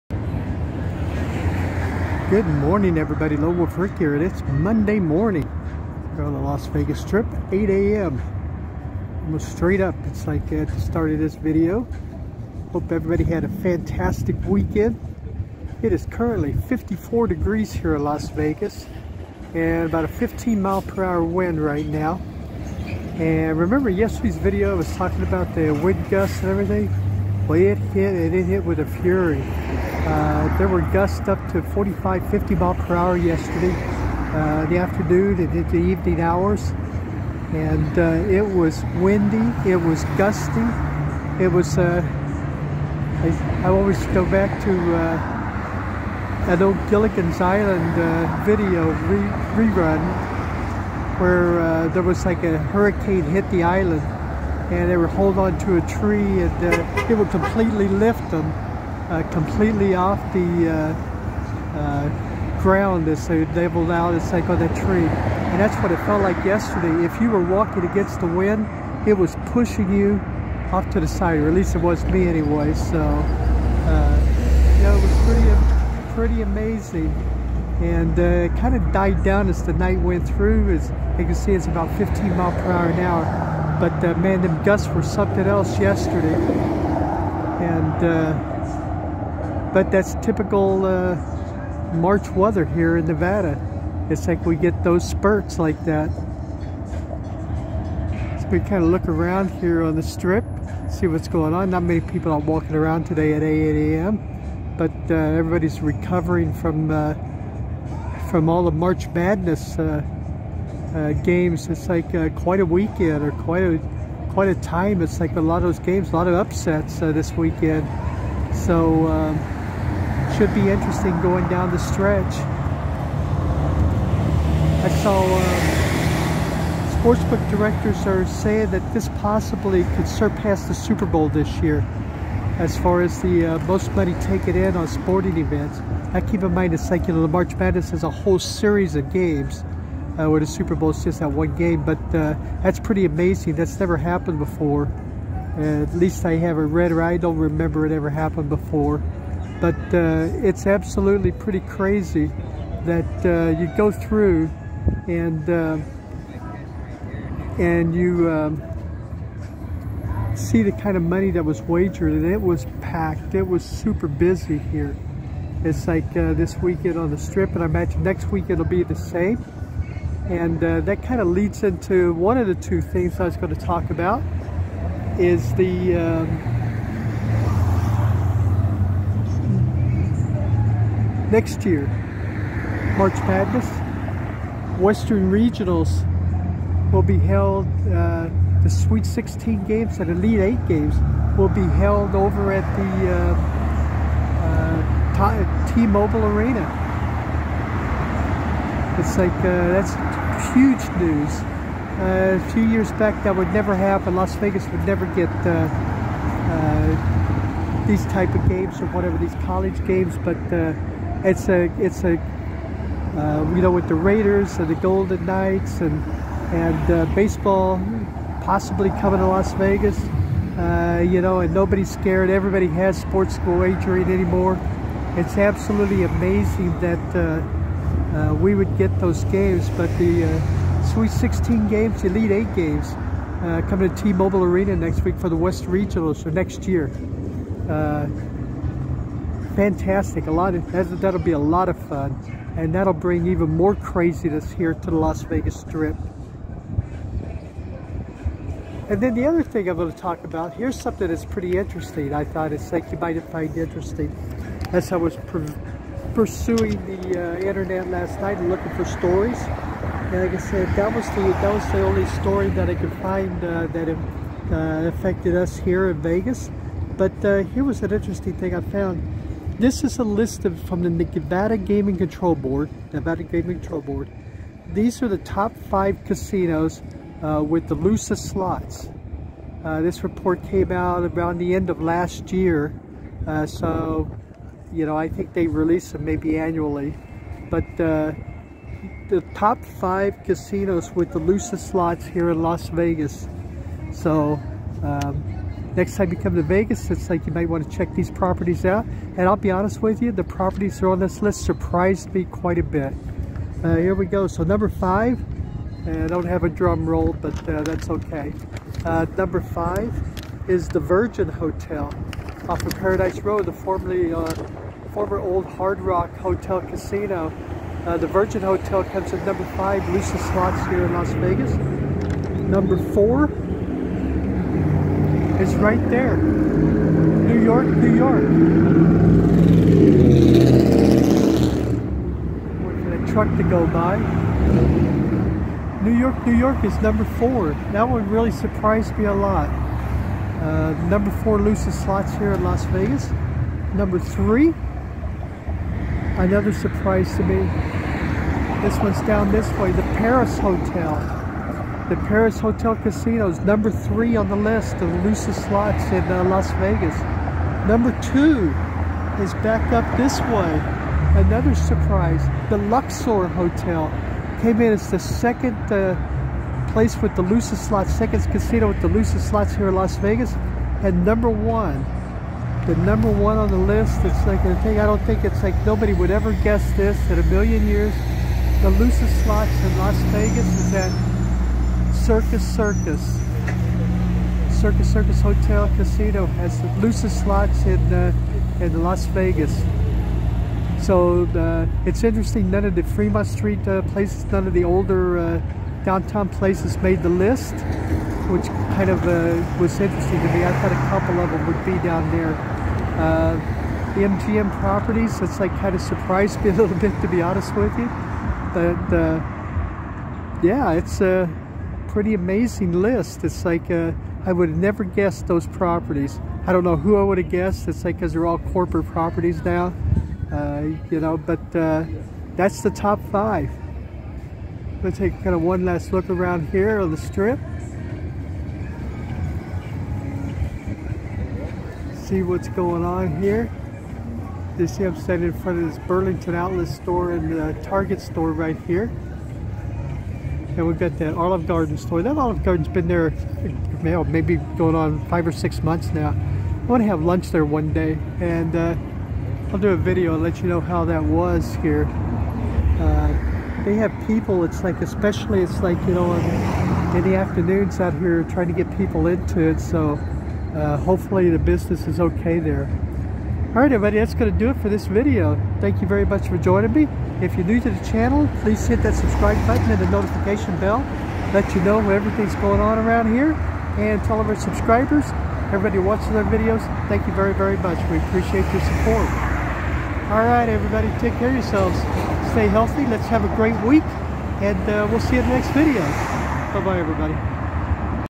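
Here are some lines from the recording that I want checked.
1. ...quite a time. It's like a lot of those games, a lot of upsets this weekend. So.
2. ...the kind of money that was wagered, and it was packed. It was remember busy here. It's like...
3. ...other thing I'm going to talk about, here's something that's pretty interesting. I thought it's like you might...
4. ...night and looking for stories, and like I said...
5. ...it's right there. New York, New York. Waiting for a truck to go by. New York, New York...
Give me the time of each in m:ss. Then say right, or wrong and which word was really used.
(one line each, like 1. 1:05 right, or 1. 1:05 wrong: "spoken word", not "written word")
1. 1:54 right
2. 2:40 wrong: "super", not "remember"
3. 4:09 right
4. 4:18 right
5. 5:25 right.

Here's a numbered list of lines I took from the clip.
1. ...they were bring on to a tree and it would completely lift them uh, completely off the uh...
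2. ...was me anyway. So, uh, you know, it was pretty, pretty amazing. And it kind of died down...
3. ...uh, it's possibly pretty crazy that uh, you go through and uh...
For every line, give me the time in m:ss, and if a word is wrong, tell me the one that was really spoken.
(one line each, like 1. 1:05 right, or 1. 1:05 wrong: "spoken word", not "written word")
1. 0:54 wrong: "holding", not "bring"
2. 1:11 right
3. 2:29 wrong: "absolutely", not "possibly".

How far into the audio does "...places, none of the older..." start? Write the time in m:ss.
6:33.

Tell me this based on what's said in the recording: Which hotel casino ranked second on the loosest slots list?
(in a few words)
Luxor.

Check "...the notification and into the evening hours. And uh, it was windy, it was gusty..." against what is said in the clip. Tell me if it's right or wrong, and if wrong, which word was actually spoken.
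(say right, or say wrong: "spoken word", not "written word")
wrong: "afternoon", not "notification".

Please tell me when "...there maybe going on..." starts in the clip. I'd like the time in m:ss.
7:22.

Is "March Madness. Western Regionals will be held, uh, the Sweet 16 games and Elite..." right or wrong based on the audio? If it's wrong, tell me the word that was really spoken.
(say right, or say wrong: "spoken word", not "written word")
right.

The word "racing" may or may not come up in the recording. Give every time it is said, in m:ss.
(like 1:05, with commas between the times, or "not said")
not said.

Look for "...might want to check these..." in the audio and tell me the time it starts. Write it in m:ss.
4:57.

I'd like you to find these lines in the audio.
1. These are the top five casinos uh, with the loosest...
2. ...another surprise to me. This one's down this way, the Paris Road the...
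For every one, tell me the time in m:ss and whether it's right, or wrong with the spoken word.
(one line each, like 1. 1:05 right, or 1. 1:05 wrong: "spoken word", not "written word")
1. 4:34 right
2. 5:46 wrong: "Hotel", not "Road".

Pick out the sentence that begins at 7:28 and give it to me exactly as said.
And uh, I'll do a video and let you know how that was here.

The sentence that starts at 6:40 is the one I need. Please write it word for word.
I thought a couple of them would be down there.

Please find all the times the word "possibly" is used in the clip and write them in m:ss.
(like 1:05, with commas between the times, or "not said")
2:09, 3:38.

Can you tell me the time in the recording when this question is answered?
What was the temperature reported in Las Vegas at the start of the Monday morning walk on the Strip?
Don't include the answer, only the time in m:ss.
0:16.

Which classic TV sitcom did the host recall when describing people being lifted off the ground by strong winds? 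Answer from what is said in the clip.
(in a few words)
Gilligan's Island.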